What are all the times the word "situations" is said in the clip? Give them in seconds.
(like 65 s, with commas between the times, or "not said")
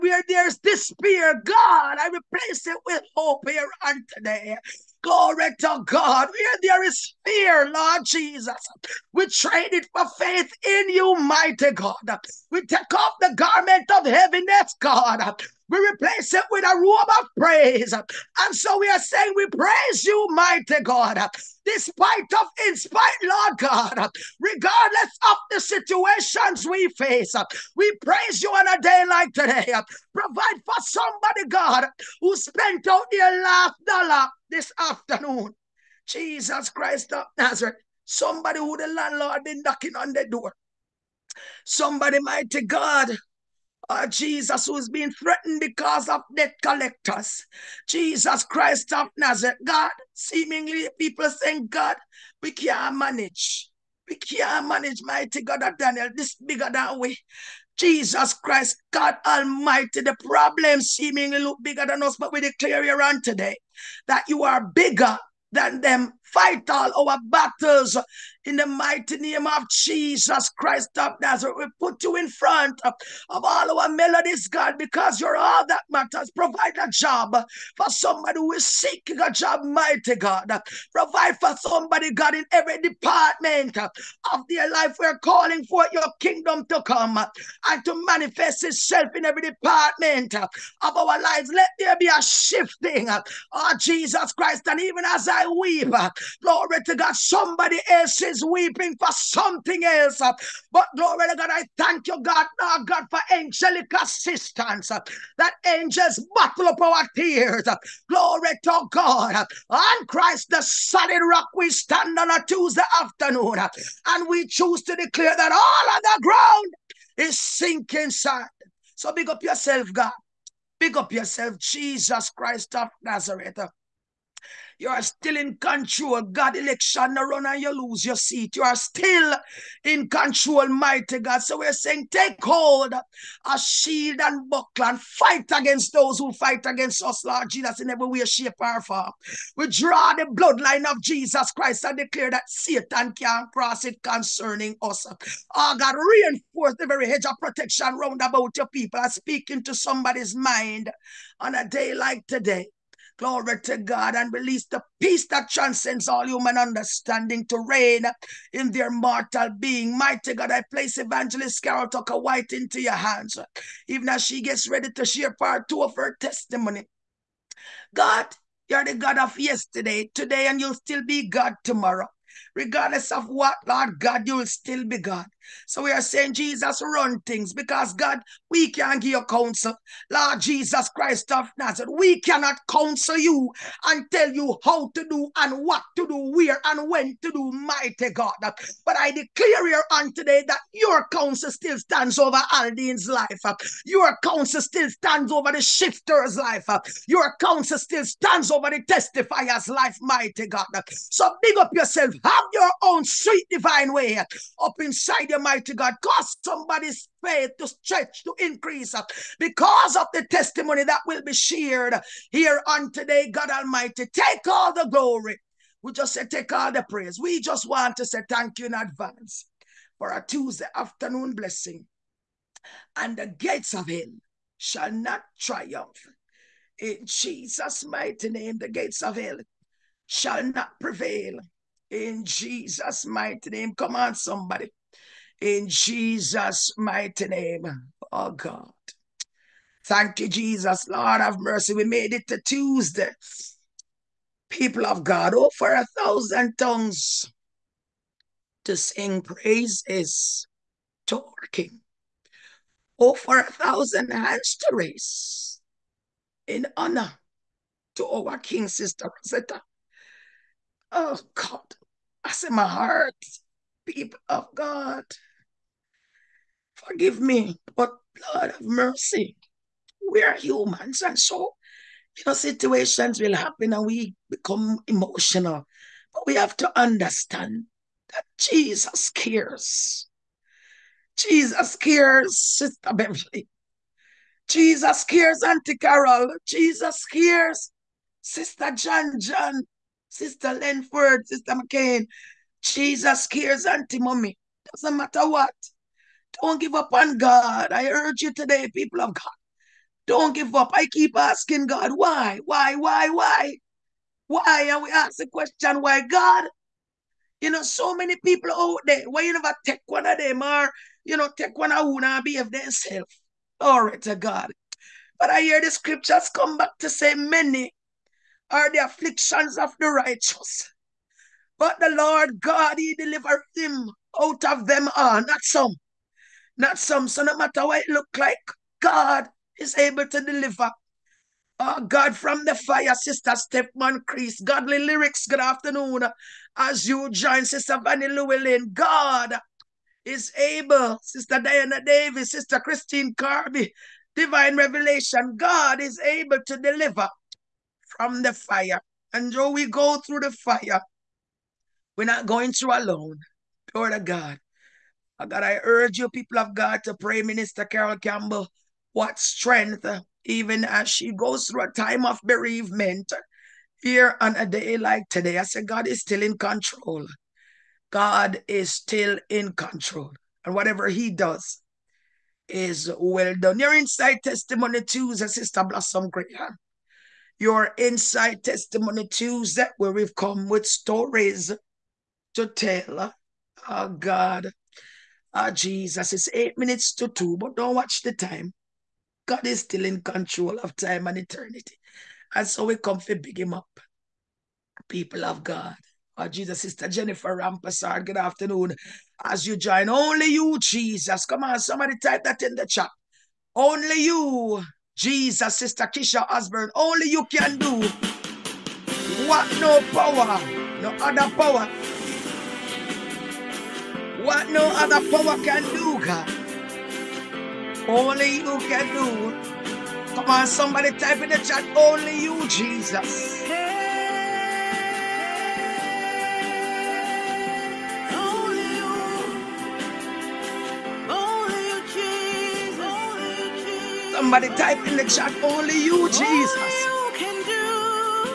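25 s, 272 s.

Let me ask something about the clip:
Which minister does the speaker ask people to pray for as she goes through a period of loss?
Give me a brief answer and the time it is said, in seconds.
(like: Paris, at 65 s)
Minister Carol Campbell, at 357 s.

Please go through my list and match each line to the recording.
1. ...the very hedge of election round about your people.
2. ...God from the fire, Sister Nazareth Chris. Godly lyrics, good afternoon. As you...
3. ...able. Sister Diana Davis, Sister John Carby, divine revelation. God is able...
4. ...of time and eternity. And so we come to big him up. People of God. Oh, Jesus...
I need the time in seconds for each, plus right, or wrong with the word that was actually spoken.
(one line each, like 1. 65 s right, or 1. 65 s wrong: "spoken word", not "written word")
1. 146 s wrong: "protection", not "election"
2. 331 s wrong: "Stepman", not "Nazareth"
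3. 340 s wrong: "Christine", not "John"
4. 390 s right.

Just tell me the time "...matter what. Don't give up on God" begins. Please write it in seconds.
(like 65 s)
294 s.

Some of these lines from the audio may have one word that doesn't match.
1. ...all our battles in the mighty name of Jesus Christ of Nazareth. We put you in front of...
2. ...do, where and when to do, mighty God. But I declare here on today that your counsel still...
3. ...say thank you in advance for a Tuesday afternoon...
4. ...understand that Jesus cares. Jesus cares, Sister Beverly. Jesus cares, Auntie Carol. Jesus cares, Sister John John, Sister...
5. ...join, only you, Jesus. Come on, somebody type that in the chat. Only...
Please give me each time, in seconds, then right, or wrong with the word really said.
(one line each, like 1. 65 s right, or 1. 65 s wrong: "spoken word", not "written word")
1. 66 s right
2. 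186 s right
3. 218 s right
4. 276 s right
5. 399 s right.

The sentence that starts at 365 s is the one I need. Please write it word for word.
I said, God is still in control.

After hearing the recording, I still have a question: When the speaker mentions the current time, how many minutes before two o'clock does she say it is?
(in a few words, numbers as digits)
8.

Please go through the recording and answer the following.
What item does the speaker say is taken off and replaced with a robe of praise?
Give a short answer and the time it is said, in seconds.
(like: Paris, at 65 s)
Garment of heaviness, at 13 s.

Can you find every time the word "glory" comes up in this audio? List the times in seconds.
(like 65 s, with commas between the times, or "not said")
5 s, 96 s, 100 s, 108 s, 153 s, 214 s, 313 s, 353 s.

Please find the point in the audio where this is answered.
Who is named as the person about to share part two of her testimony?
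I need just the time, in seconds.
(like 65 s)
160 s.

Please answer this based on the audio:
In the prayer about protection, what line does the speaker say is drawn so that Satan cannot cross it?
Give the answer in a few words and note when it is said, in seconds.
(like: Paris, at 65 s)
Bloodline of Jesus Christ, at 140 s.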